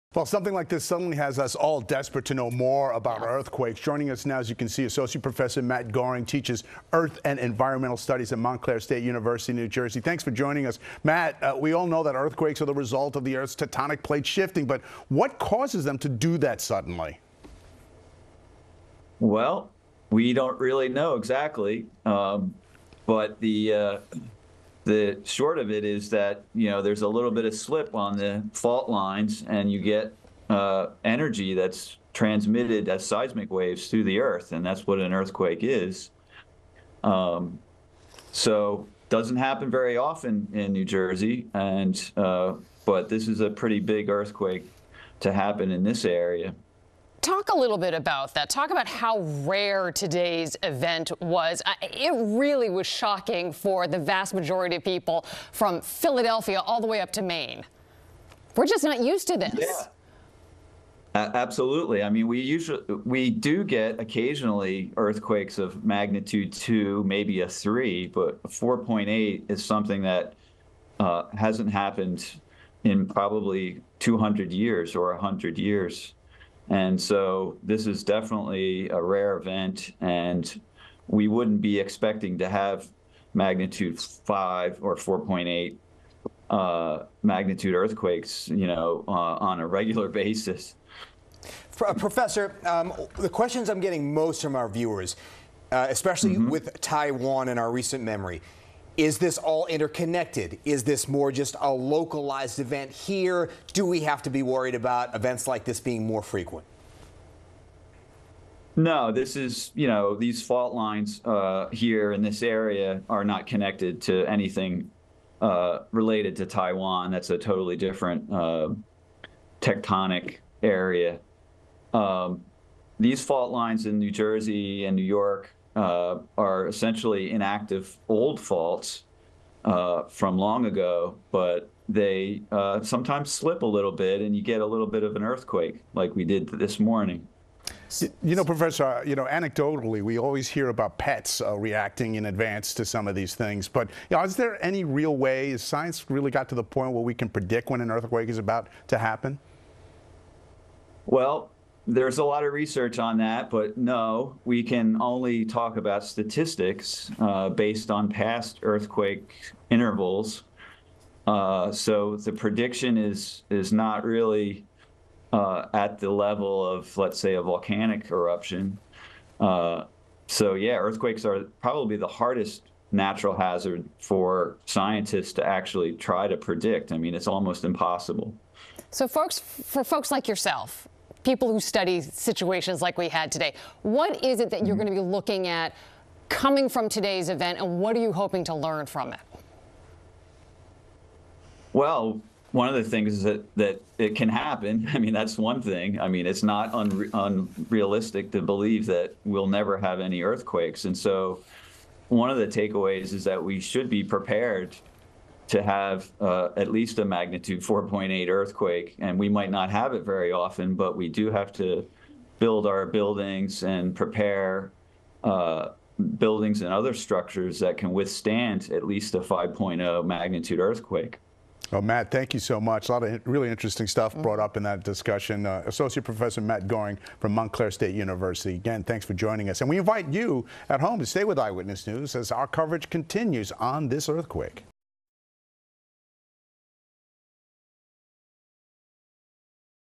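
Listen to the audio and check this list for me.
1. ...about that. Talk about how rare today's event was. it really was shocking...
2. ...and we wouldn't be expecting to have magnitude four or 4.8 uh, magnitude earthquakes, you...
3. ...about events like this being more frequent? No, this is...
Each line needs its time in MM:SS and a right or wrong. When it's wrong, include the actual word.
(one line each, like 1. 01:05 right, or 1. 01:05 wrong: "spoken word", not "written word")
1. 00:47 right
2. 01:20 wrong: "five", not "four"
3. 01:44 right.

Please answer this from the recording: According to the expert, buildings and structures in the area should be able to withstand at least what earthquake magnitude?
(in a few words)
5.0.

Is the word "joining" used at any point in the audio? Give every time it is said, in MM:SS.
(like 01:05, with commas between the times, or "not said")
00:03, 00:10, 03:49.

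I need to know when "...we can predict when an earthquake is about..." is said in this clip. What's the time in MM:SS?
02:27.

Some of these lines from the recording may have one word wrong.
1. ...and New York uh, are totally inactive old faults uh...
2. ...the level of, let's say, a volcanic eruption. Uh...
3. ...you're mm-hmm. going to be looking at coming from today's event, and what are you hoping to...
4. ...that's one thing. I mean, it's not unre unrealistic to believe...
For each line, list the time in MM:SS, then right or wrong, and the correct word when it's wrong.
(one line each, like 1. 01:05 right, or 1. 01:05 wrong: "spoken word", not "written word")
1. 02:04 wrong: "essentially", not "totally"
2. 02:45 right
3. 03:04 right
4. 03:15 right.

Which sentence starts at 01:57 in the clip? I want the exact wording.
That's a totally different uh, tectonic area.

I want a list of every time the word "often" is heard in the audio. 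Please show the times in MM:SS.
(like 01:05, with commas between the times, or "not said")
00:39, 03:30.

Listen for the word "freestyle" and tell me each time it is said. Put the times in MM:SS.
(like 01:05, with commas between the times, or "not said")
not said.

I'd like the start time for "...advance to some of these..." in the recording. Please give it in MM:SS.
02:22.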